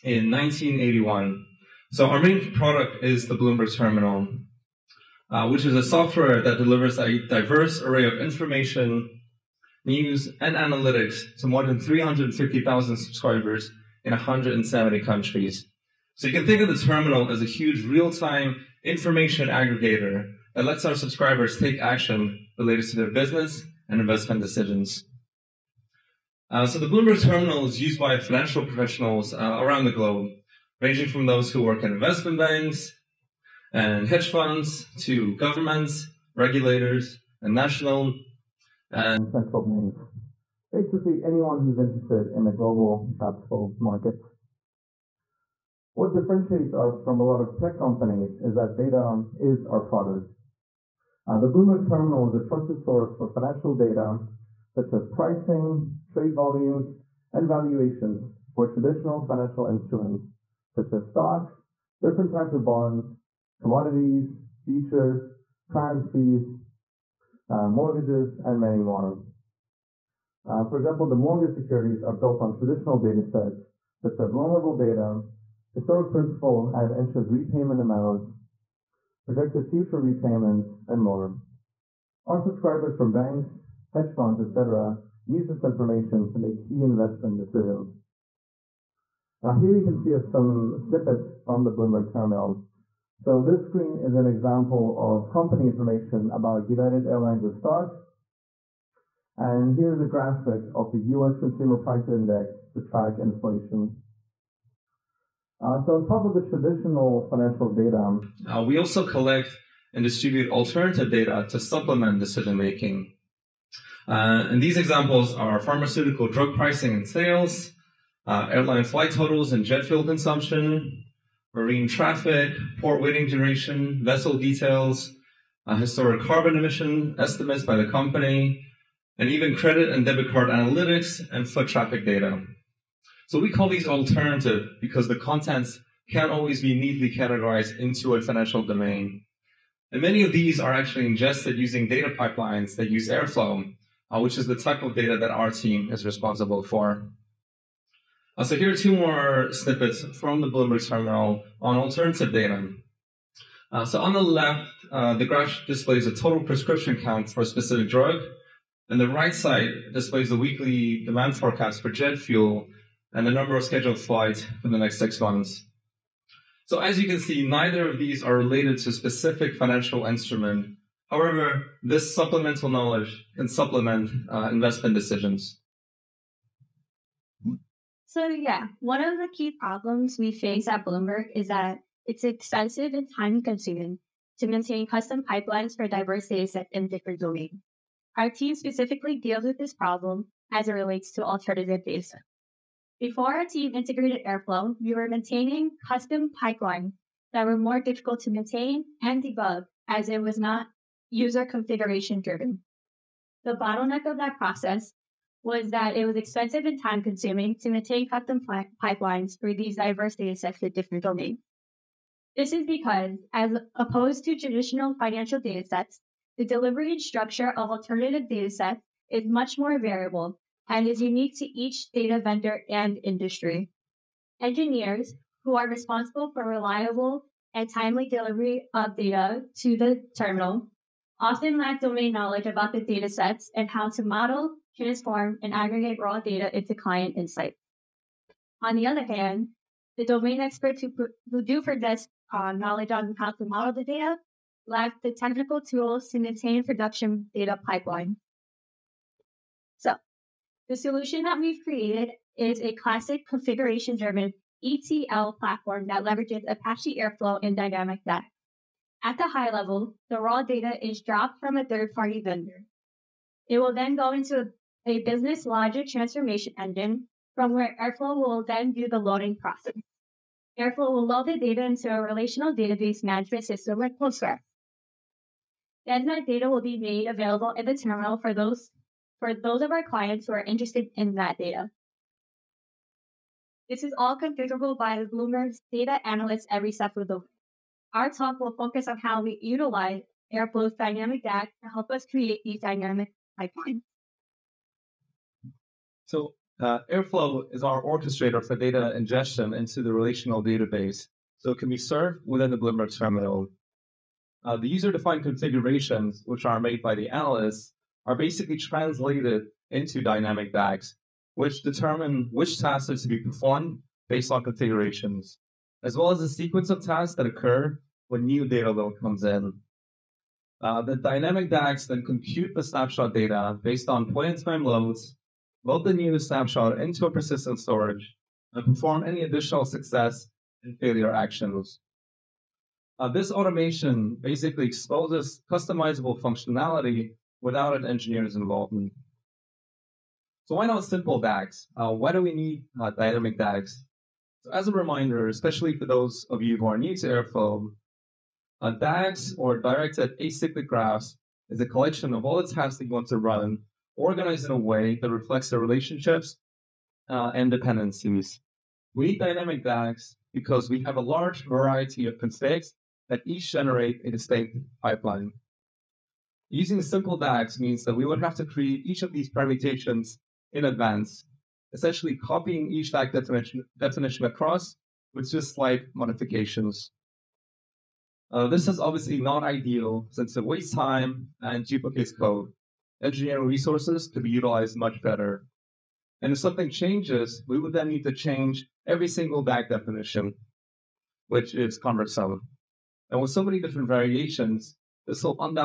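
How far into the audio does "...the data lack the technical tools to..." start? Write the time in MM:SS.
04:03.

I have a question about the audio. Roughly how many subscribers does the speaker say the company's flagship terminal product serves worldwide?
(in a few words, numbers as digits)
350,000.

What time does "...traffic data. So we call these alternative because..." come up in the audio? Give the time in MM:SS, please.
02:11.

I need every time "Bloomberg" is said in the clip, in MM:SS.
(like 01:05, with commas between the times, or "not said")
00:03, 00:26, 00:51, 01:31, 02:30, 03:00, 04:45, 05:02.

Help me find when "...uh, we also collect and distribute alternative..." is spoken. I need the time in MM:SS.
01:48.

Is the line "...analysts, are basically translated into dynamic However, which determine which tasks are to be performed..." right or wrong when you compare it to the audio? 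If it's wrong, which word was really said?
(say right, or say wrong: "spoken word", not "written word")
wrong: "DAGs", not "However".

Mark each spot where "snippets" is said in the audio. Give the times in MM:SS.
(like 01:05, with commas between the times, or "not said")
01:30, 02:29.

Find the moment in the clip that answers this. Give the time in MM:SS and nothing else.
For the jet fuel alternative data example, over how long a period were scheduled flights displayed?
02:44.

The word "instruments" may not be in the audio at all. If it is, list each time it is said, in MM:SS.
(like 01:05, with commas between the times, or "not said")
00:59, 02:50.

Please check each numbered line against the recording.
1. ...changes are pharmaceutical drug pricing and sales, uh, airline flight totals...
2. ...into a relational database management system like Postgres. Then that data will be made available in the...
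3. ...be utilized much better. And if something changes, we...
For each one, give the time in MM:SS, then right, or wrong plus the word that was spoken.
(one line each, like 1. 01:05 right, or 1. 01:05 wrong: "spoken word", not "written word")
1. 01:54 wrong: "examples", not "changes"
2. 04:31 right
3. 06:24 right.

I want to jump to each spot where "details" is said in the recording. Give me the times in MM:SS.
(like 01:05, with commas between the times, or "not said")
02:04.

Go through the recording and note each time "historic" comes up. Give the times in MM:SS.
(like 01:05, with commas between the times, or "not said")
01:15, 02:05.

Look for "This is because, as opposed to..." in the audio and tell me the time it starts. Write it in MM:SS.
03:32.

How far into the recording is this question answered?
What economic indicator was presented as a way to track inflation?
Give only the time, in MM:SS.
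01:41.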